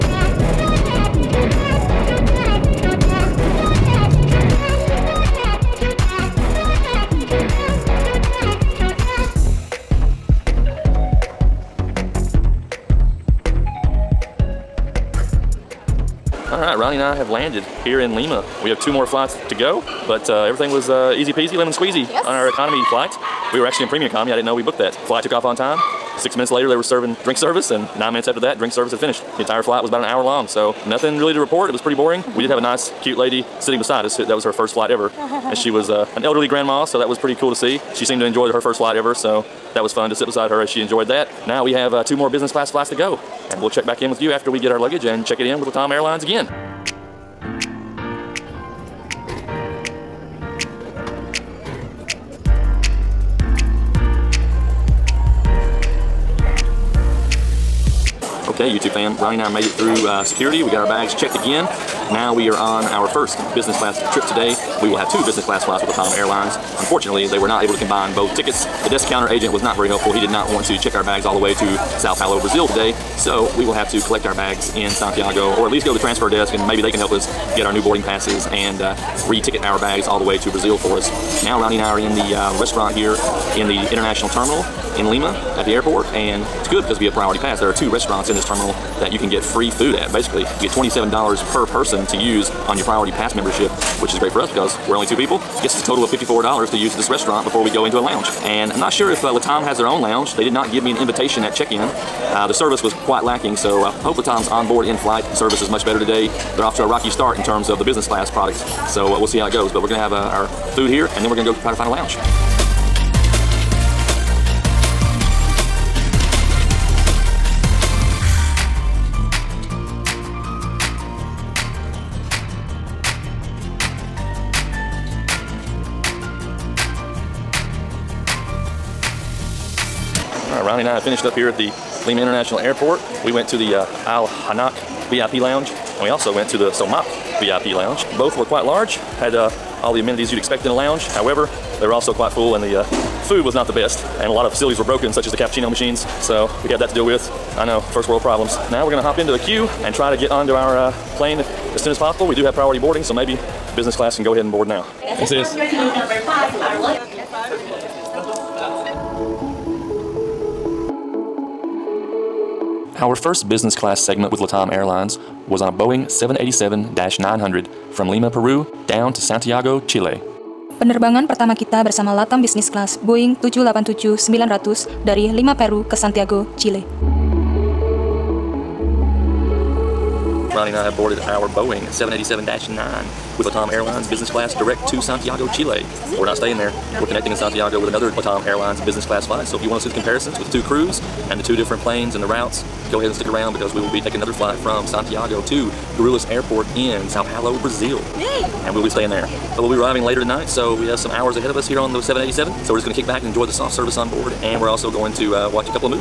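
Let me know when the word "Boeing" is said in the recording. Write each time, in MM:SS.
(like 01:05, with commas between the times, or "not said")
02:45, 02:53, 03:01.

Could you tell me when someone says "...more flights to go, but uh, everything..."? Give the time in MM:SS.
00:18.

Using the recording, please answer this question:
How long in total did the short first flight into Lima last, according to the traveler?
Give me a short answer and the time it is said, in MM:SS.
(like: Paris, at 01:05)
about an hour, at 00:29.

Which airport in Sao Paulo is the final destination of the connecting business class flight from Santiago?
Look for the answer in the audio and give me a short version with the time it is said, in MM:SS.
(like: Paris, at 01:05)
Guarulhos Airport, at 03:15.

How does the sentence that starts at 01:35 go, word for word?
Gets us a total of $54 to use this restaurant before we go into a lounge.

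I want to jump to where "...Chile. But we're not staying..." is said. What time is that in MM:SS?
03:05.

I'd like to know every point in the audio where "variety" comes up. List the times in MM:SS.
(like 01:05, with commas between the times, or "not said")
not said.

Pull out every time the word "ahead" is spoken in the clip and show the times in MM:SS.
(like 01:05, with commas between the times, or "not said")
02:34, 03:13, 03:21.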